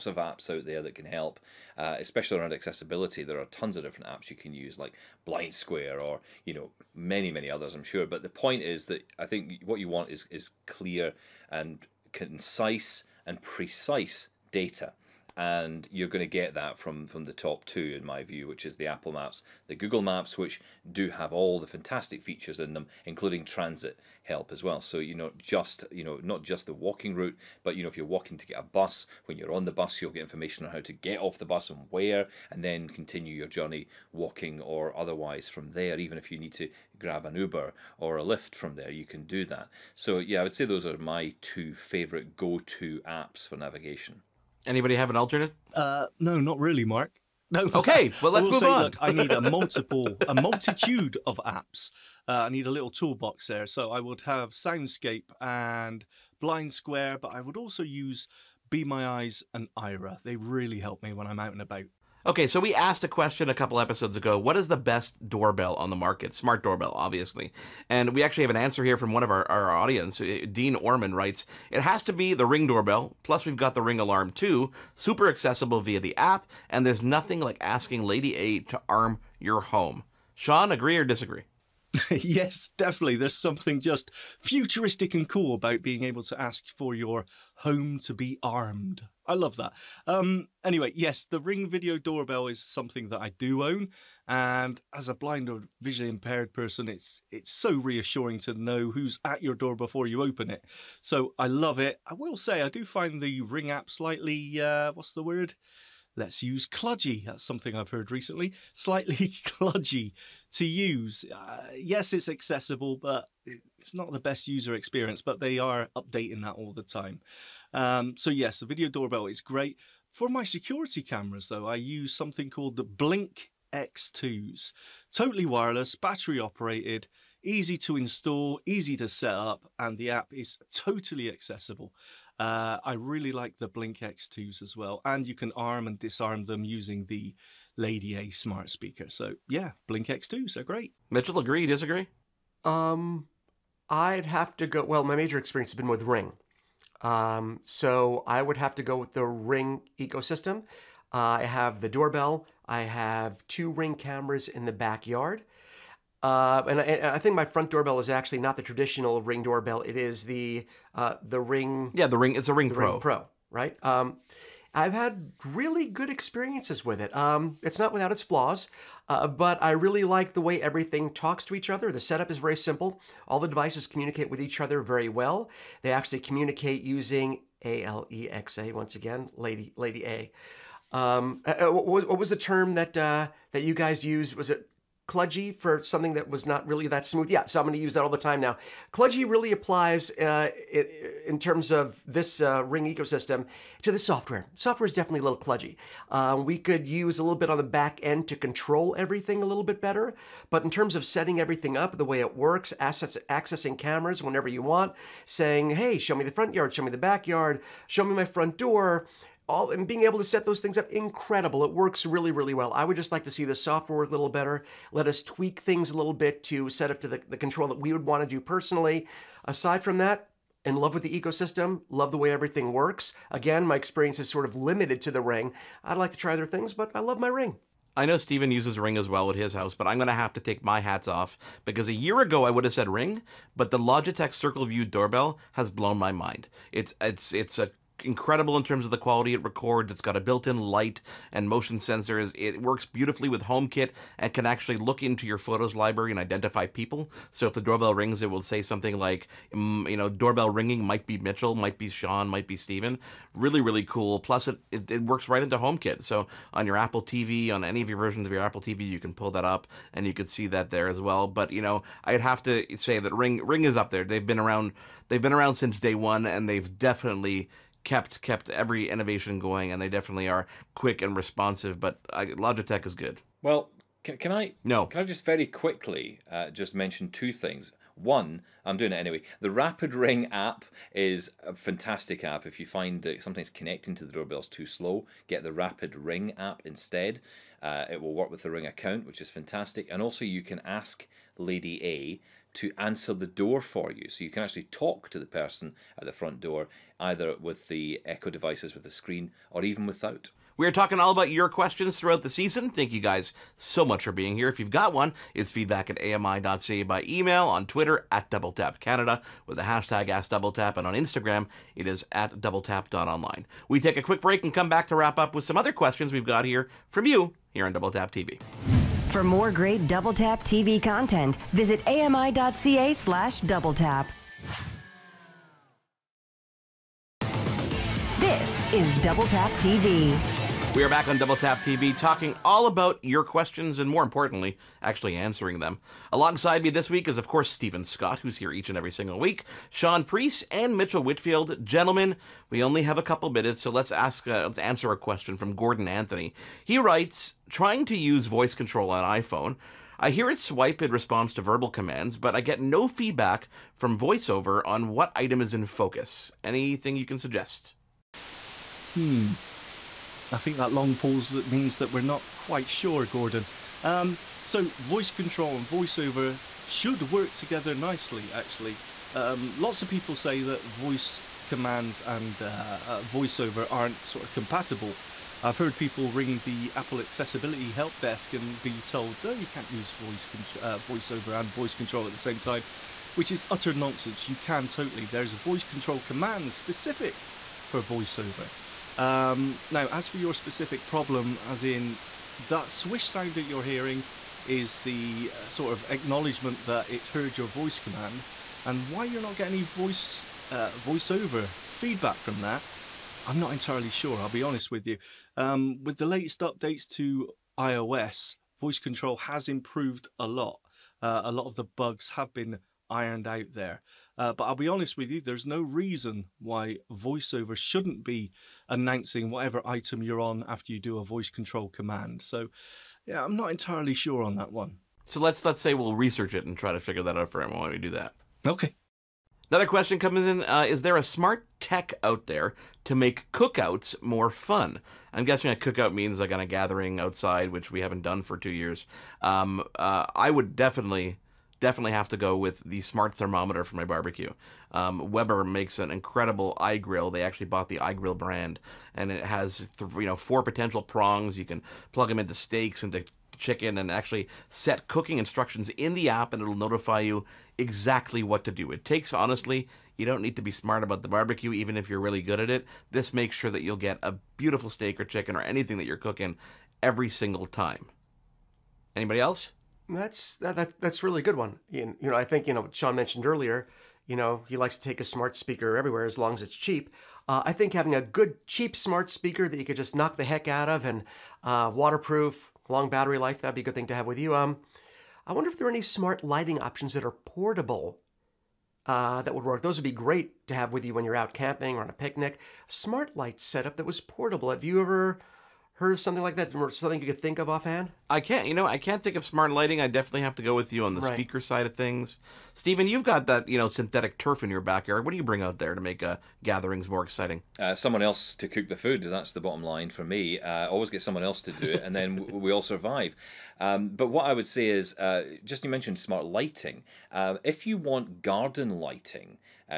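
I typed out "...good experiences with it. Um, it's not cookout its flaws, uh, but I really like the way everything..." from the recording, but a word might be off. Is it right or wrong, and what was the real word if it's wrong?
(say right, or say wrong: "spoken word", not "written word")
wrong: "without", not "cookout".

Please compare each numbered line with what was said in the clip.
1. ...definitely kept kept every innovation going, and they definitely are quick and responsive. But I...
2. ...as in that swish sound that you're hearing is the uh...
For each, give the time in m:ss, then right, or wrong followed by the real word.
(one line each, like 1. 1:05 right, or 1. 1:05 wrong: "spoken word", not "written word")
1. 4:26 right
2. 6:31 right.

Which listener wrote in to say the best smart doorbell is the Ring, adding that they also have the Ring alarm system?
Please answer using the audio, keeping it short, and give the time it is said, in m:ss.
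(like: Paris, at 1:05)
Dean Orman, at 1:10.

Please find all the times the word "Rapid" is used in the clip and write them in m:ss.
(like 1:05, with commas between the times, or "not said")
4:39, 4:45.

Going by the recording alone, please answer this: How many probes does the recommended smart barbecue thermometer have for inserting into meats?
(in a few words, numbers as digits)
4.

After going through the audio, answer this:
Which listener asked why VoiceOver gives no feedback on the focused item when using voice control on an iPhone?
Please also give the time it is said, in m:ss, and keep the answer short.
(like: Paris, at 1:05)
Gordon Anthony, at 5:45.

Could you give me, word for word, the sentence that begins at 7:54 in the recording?
You know, he likes to take a smart speaker everywhere as long as it's cheap.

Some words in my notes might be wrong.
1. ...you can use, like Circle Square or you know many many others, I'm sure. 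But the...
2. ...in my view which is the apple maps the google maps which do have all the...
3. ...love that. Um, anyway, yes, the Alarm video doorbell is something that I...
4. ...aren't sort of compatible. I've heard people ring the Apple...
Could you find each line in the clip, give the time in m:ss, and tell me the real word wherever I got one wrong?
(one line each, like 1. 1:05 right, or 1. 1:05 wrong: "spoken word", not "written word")
1. 0:04 wrong: "Blind", not "Circle"
2. 0:17 right
3. 1:29 wrong: "Ring", not "Alarm"
4. 6:13 right.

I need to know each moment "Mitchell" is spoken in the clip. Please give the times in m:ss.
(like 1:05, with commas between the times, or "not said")
2:21, 4:11, 5:40.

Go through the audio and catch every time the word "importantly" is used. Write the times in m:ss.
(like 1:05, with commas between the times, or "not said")
5:34.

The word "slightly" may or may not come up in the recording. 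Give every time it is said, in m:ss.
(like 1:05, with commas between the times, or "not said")
1:43, 1:48.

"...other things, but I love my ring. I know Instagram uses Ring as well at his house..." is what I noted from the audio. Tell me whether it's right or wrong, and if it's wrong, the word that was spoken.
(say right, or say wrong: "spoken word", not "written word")
wrong: "Stephen", not "Instagram".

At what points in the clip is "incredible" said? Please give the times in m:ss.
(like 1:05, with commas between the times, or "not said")
3:30, 3:58, 7:25.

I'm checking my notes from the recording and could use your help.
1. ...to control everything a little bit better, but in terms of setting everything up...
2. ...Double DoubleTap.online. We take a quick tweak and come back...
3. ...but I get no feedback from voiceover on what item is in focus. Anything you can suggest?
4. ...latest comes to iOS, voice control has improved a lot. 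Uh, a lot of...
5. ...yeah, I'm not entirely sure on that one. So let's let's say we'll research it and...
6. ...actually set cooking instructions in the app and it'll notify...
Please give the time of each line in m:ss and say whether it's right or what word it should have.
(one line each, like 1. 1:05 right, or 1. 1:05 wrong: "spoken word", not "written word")
1. 3:18 right
2. 5:12 wrong: "break", not "tweak"
3. 5:52 right
4. 6:46 wrong: "updates", not "comes"
5. 7:03 right
6. 7:33 right.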